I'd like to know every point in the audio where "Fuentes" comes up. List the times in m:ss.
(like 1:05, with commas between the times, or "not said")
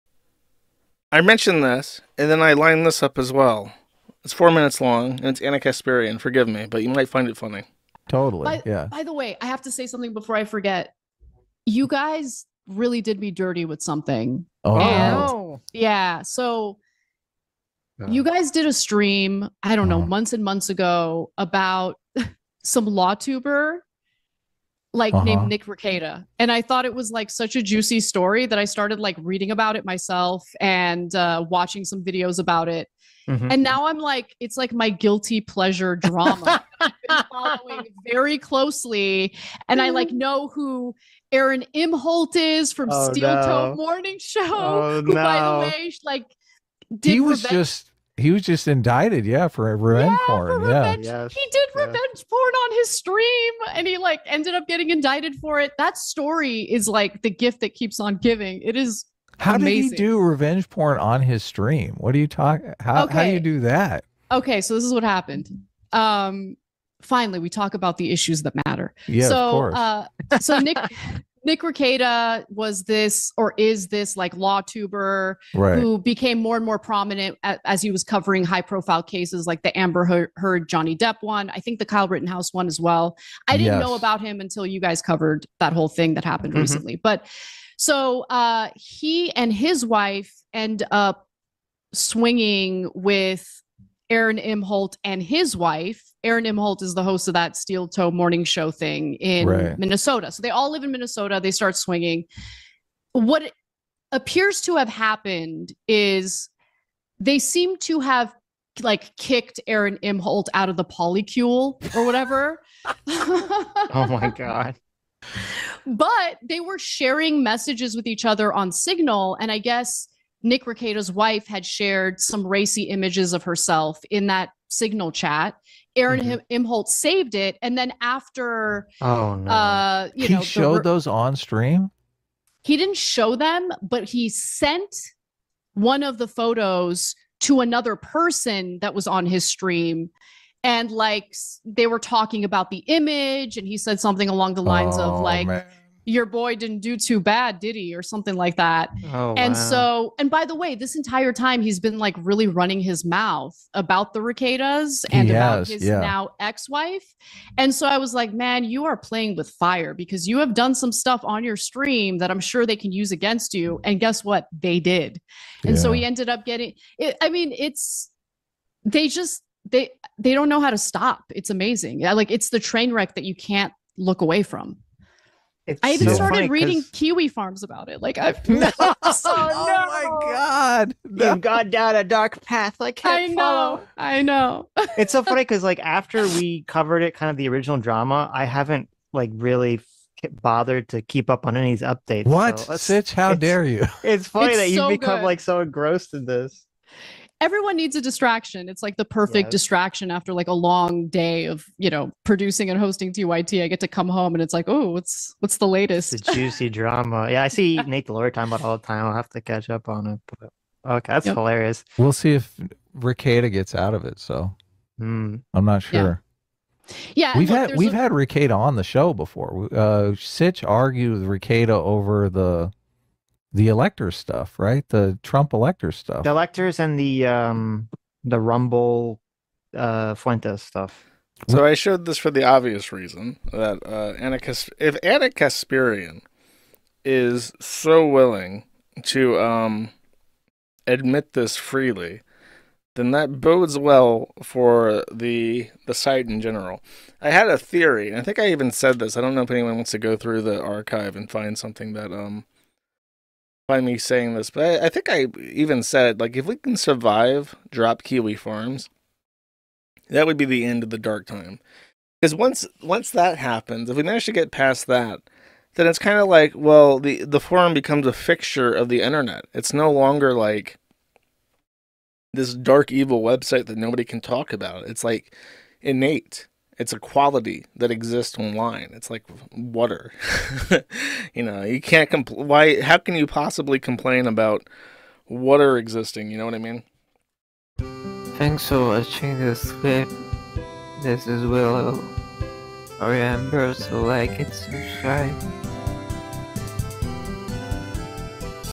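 3:50.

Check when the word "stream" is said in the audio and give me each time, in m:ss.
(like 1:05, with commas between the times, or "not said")
0:18, 0:52, 1:01, 2:11, 2:19, 2:41.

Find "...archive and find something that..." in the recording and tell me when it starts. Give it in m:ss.
4:10.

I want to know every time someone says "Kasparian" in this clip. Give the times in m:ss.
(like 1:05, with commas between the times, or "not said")
0:05, 3:55.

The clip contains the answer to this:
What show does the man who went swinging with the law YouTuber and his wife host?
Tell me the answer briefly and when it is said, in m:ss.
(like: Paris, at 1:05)
Steel Toe Morning Show, at 1:37.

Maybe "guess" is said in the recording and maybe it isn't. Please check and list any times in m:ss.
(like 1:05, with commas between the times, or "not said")
1:59, 2:43.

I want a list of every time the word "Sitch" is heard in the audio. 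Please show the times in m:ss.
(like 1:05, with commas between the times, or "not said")
3:12, 3:40.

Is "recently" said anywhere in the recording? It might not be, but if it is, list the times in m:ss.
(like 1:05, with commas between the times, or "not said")
1:26.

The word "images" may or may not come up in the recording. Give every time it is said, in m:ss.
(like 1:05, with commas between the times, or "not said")
2:02, 2:22.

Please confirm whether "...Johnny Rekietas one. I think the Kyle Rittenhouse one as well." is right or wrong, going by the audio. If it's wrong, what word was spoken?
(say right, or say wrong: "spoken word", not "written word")
wrong: "Depp", not "Rekietas".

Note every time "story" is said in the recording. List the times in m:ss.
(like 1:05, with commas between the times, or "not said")
0:27, 0:55.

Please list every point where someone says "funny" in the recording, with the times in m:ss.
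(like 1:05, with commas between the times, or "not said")
0:07, 3:05, 3:14.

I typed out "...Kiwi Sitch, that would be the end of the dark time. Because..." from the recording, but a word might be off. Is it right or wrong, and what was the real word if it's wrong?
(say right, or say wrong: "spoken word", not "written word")
wrong: "Farms", not "Sitch".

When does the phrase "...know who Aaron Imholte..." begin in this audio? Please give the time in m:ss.
0:40.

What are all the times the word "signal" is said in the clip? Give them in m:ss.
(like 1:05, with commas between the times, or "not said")
1:58, 2:04.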